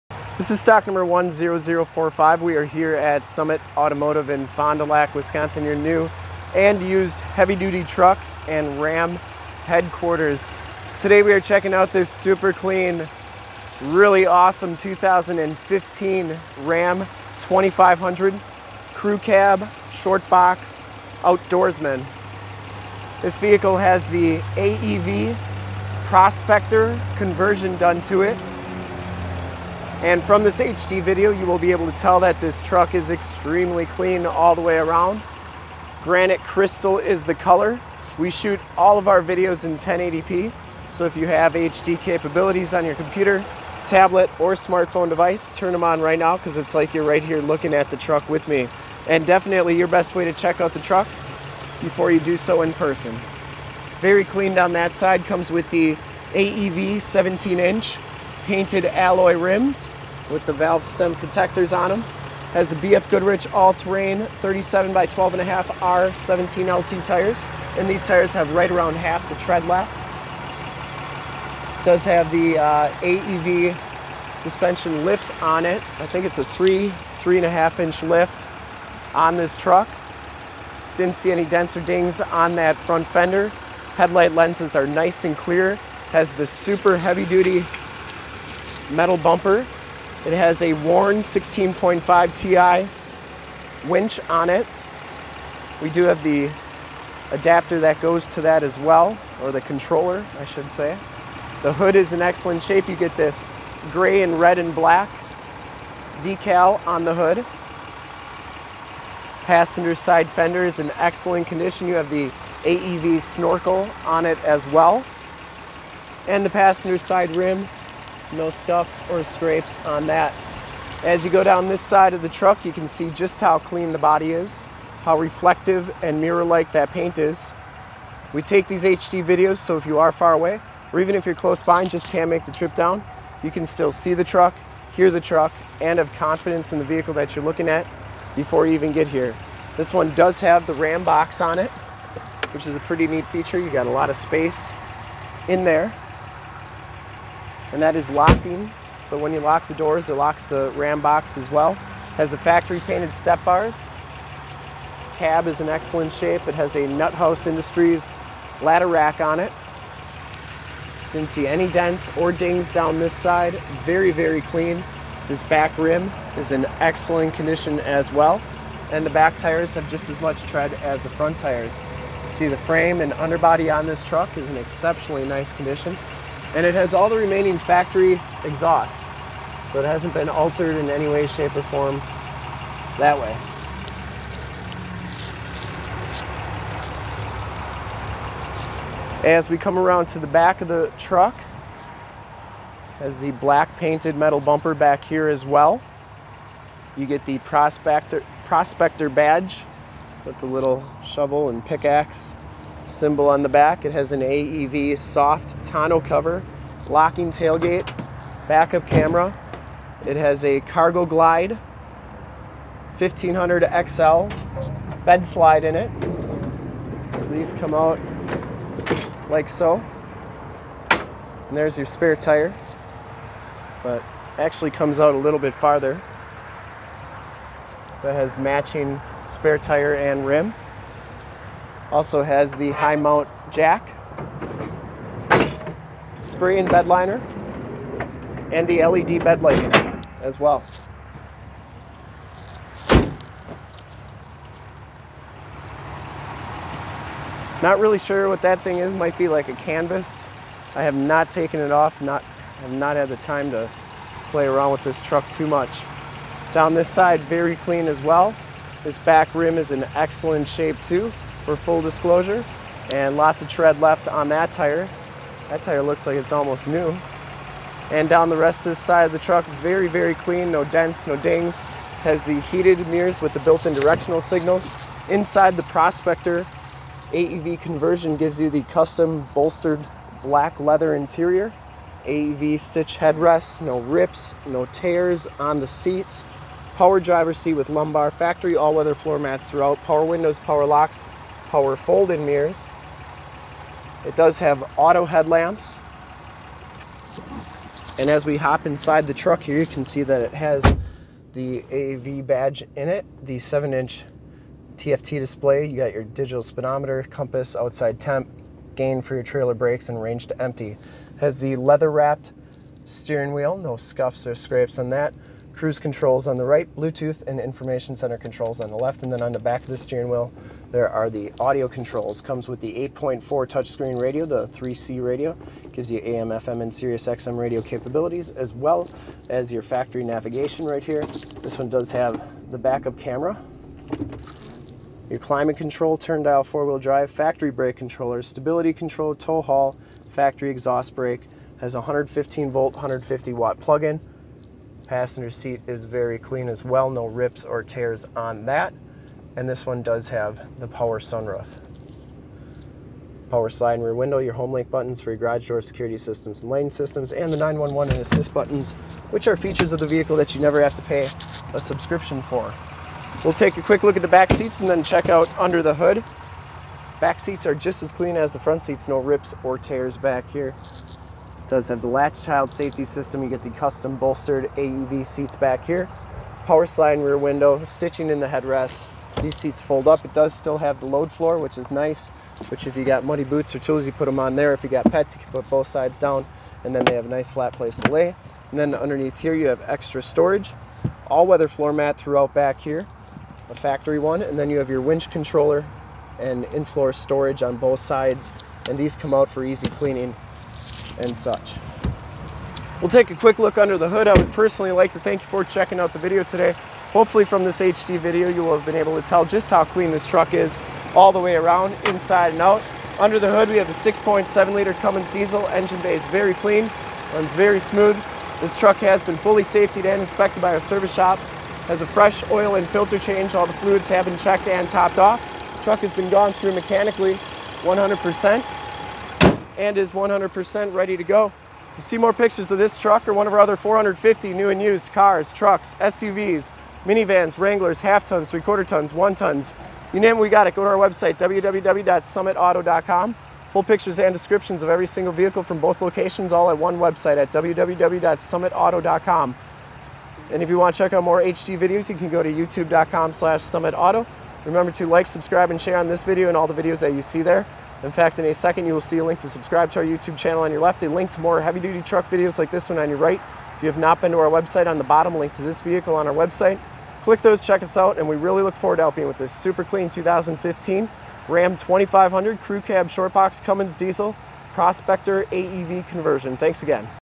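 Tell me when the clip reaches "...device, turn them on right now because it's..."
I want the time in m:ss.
0:45.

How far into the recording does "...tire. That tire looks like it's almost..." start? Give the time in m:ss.
4:24.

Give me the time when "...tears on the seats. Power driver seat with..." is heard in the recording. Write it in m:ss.
4:44.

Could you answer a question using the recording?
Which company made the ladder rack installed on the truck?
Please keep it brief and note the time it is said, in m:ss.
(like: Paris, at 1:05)
Nut House Industries, at 2:36.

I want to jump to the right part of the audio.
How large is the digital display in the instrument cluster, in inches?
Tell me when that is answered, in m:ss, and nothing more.
5:03.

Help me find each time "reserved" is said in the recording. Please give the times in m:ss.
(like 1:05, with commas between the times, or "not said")
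not said.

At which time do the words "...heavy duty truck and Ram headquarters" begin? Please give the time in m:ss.
0:07.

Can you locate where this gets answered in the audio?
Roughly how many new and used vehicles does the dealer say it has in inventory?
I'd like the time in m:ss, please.
7:13.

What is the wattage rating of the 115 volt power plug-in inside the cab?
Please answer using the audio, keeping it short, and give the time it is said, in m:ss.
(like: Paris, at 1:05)
150 watts, at 5:42.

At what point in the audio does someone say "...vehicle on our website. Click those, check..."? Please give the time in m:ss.
7:45.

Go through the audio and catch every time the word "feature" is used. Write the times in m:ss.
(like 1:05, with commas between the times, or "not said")
2:23, 5:59.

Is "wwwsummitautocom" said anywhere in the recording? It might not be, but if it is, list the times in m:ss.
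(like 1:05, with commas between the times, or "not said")
7:21, 7:27.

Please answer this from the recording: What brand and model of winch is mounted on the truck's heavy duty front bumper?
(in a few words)
Warn 16.5 Ti.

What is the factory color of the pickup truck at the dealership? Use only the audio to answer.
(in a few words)
Granite crystal.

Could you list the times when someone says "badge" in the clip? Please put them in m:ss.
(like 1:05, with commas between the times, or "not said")
3:19, 5:02.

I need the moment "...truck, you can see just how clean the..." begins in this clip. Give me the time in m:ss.
2:02.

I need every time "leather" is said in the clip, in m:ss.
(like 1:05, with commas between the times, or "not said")
4:40, 5:11.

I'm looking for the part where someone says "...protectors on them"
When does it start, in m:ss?
1:01.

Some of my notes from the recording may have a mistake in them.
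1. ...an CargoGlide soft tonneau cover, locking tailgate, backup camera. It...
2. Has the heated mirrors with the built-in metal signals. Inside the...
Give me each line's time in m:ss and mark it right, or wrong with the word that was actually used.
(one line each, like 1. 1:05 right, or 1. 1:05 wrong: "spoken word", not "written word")
1. 3:24 wrong: "AEV", not "CargoGlide"
2. 4:32 wrong: "directional", not "metal".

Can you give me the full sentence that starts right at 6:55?
Engine bay is very clean, runs very smooth.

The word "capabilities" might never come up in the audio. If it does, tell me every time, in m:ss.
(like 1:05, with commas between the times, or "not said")
0:42, 5:27.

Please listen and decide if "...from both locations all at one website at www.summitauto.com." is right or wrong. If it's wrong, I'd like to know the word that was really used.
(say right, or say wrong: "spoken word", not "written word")
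right.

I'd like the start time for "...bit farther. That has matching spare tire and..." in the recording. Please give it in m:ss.
3:45.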